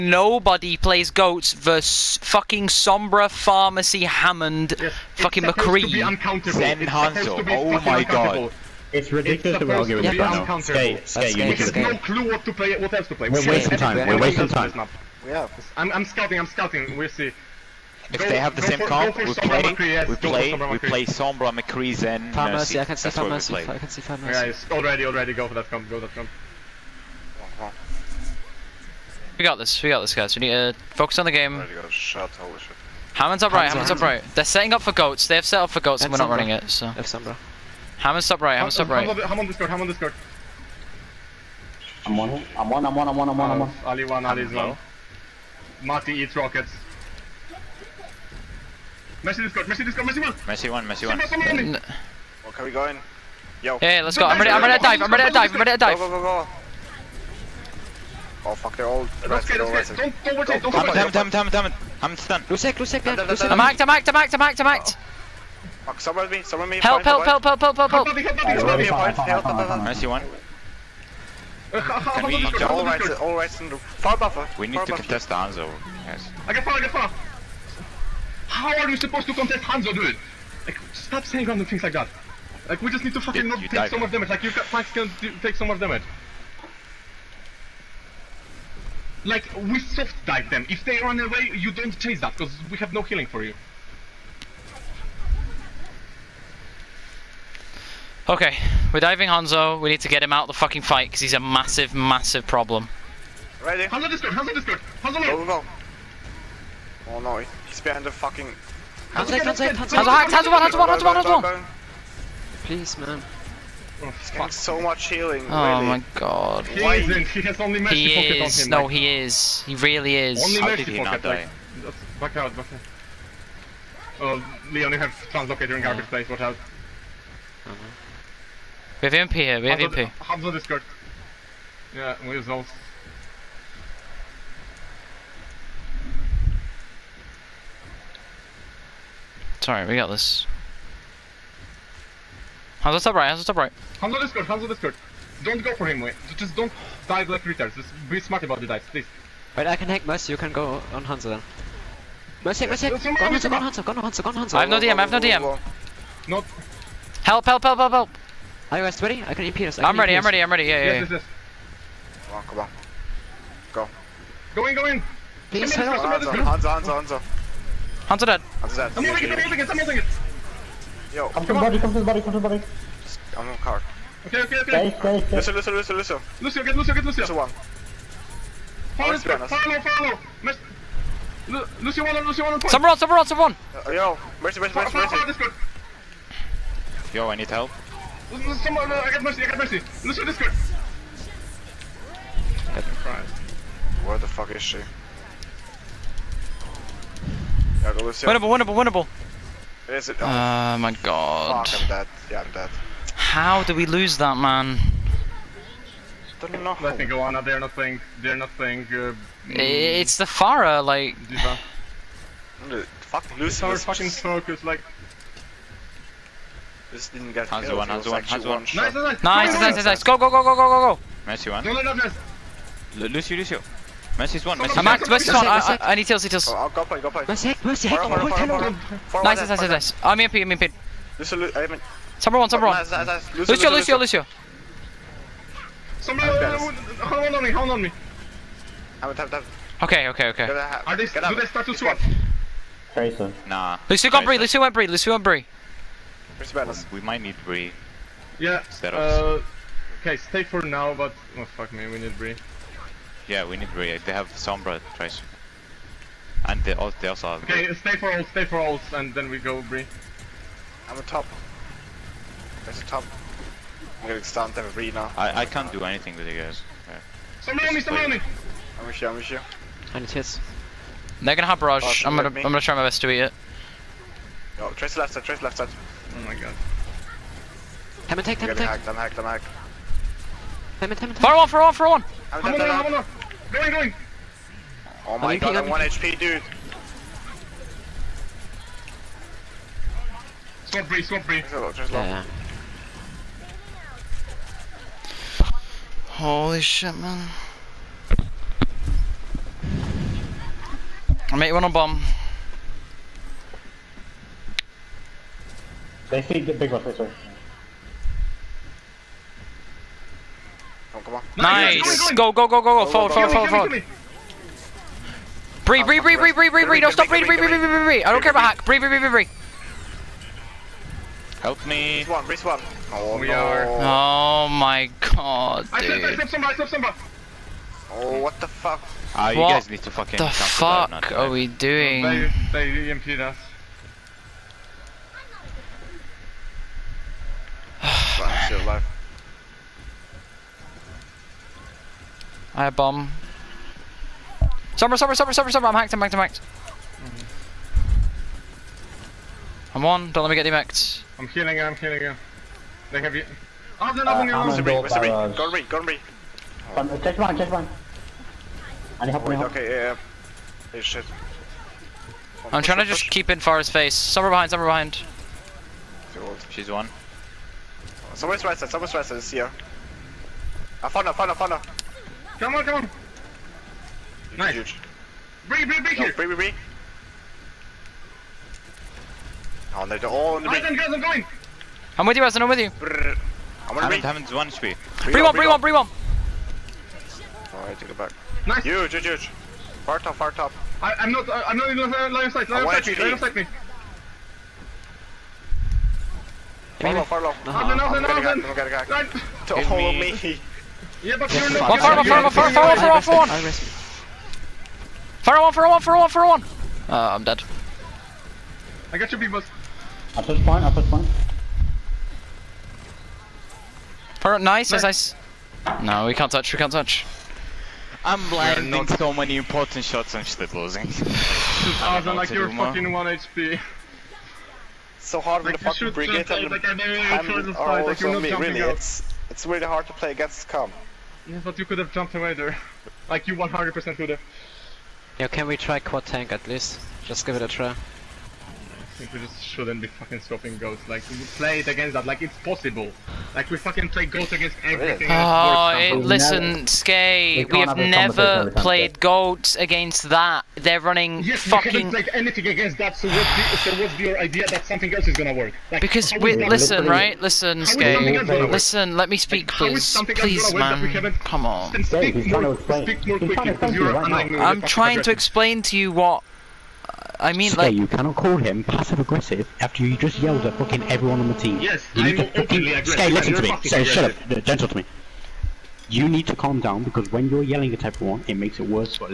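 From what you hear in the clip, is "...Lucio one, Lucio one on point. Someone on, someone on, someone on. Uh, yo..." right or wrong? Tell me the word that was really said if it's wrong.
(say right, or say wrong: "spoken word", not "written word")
right.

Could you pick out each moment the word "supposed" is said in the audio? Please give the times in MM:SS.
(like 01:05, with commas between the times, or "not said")
01:18.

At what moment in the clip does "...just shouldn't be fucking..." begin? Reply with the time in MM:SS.
07:19.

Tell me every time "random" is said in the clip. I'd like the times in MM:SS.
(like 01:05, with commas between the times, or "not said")
01:21.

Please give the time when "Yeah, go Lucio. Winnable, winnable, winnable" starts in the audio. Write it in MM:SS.
03:17.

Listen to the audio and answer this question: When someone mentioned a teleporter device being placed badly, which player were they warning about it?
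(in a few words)
Leon.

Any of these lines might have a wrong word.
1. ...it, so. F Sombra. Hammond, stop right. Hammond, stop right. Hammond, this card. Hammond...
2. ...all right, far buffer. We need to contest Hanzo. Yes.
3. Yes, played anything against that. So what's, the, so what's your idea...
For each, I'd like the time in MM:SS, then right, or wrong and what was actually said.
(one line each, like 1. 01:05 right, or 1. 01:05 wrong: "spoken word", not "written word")
1. 00:36 right
2. 01:13 right
3. 07:31 right.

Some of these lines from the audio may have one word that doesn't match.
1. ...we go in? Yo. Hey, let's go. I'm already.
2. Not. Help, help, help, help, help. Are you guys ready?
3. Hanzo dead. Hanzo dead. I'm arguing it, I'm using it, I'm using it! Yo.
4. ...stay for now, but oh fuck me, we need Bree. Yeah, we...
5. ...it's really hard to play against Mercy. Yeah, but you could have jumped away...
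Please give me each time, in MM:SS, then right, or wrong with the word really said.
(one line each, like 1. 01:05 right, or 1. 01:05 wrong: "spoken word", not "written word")
1. 00:52 wrong: "ready", not "already"
2. 02:36 right
3. 02:48 wrong: "using", not "arguing"
4. 04:10 right
5. 07:09 wrong: "Scum", not "Mercy".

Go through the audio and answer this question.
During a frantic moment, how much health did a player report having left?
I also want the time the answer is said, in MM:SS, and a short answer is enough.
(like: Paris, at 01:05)
1 HP, at 04:45.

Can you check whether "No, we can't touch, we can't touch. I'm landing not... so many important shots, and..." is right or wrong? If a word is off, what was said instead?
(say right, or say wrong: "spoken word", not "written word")
right.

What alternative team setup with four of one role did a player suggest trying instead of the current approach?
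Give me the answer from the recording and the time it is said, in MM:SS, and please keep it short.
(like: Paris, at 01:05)
Quad tank, at 07:15.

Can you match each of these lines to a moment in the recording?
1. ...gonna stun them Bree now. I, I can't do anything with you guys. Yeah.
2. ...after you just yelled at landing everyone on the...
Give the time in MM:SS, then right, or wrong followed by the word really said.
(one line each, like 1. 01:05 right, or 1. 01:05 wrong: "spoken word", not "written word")
1. 04:24 right
2. 07:49 wrong: "fucking", not "landing".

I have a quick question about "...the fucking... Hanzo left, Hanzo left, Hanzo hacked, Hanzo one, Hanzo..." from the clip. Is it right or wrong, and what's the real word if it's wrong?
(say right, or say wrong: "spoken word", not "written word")
right.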